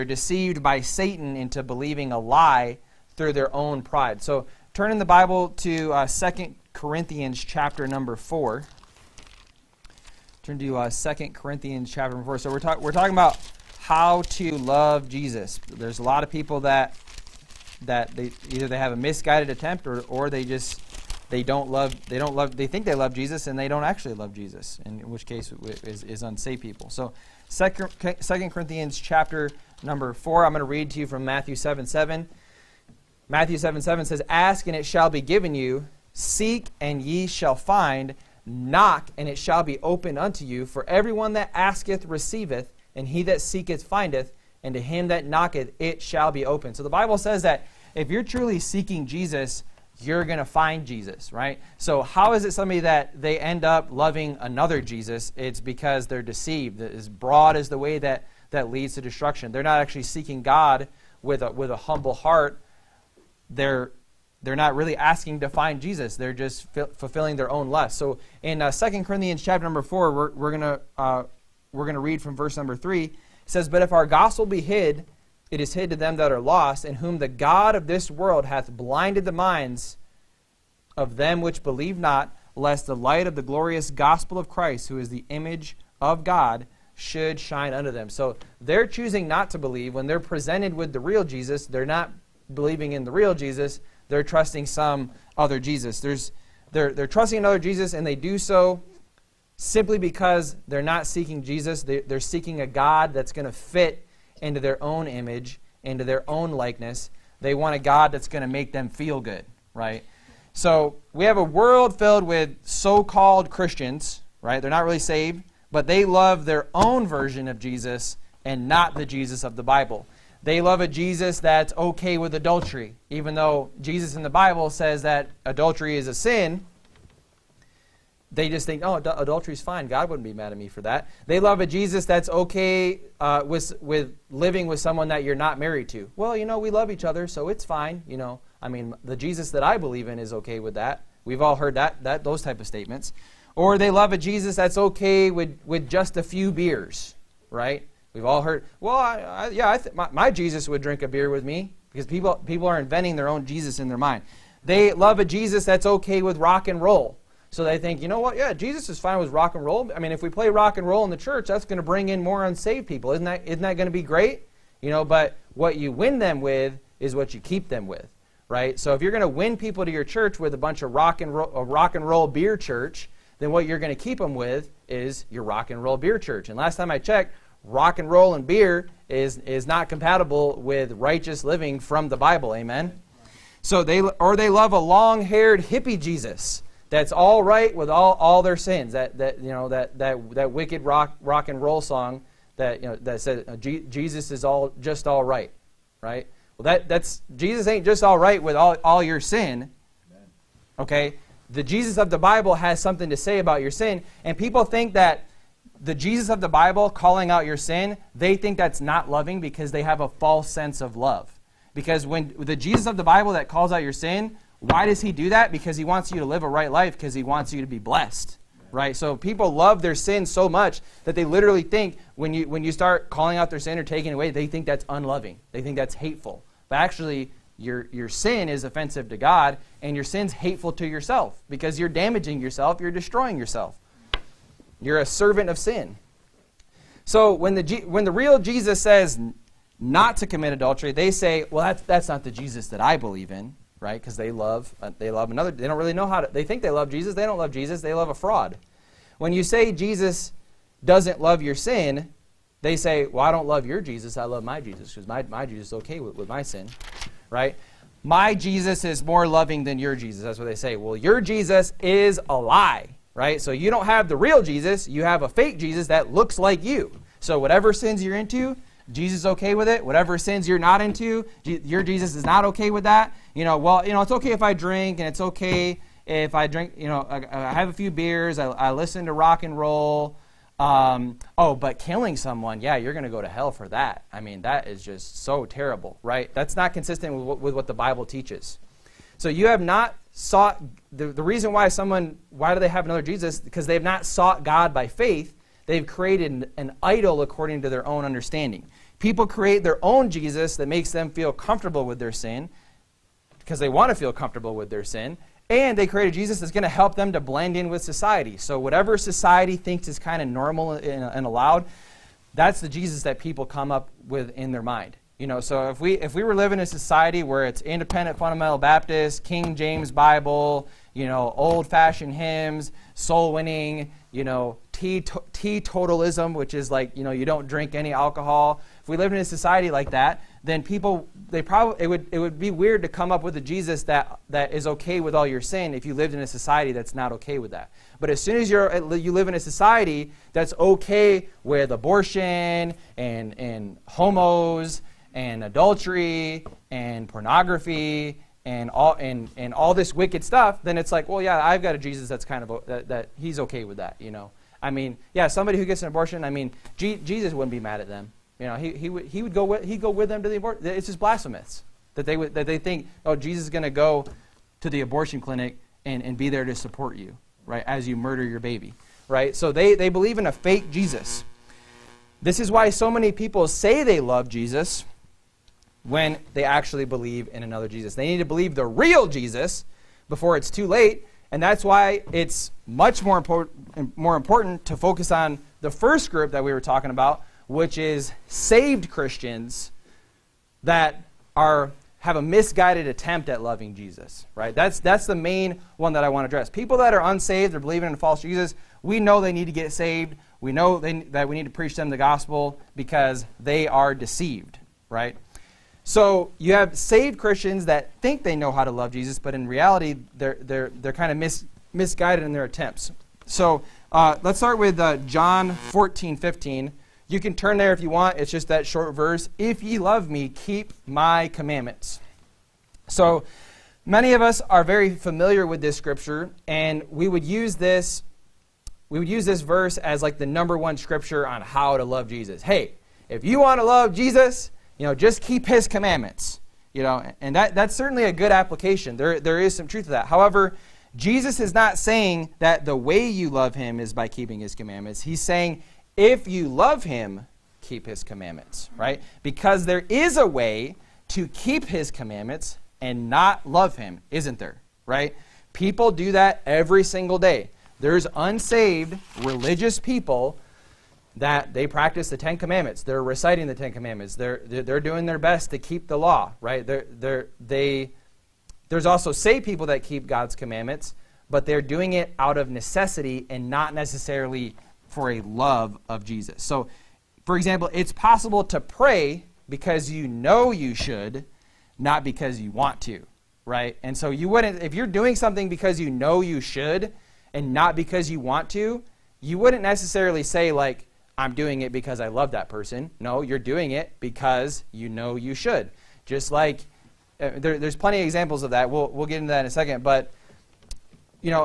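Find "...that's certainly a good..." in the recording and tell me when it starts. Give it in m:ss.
7:17.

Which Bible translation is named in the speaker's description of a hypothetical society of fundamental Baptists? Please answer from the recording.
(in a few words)
King James Bible.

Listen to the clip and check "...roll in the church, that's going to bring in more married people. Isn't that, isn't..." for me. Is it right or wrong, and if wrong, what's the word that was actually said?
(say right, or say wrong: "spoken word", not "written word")
wrong: "unsaved", not "married".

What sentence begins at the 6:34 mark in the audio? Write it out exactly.
That's, that's the main one that I want to address.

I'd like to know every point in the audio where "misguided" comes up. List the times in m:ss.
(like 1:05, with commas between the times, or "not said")
0:18, 6:32, 6:51.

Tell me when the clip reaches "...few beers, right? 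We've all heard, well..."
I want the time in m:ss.
2:26.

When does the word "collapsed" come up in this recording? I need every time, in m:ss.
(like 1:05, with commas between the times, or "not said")
not said.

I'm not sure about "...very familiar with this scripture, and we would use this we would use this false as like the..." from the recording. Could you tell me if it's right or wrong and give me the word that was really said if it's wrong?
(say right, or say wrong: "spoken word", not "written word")
wrong: "verse", not "false".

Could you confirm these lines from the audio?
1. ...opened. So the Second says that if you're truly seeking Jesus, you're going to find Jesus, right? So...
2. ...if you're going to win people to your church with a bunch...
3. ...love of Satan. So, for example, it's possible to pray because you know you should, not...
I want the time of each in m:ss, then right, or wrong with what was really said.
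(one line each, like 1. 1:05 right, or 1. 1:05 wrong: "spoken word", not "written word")
1. 0:46 wrong: "Bible", not "Second"
2. 2:48 right
3. 7:55 wrong: "Jesus", not "Satan".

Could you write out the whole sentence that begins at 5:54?
I mean, yeah, somebody who gets an abortion, I mean, G Jesus wouldn't be mad at them.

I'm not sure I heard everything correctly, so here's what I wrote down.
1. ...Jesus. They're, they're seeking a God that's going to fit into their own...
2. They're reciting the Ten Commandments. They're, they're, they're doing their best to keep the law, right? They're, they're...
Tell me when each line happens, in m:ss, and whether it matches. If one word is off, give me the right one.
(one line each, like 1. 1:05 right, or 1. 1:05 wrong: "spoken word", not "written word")
1. 1:41 right
2. 7:42 right.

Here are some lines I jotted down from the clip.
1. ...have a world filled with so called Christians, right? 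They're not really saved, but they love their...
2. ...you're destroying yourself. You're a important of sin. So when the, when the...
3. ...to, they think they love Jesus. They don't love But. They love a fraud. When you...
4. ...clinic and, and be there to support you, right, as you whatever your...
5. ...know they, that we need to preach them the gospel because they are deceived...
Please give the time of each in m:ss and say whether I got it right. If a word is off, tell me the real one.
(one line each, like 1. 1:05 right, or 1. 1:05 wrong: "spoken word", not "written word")
1. 1:51 right
2. 3:52 wrong: "servant", not "important"
3. 4:06 wrong: "Jesus", not "But"
4. 6:05 wrong: "murder", not "whatever"
5. 6:40 right.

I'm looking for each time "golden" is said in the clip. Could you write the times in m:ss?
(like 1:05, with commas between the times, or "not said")
not said.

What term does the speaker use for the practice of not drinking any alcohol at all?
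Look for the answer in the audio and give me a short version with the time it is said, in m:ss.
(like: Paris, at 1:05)
Teetotalism, at 5:24.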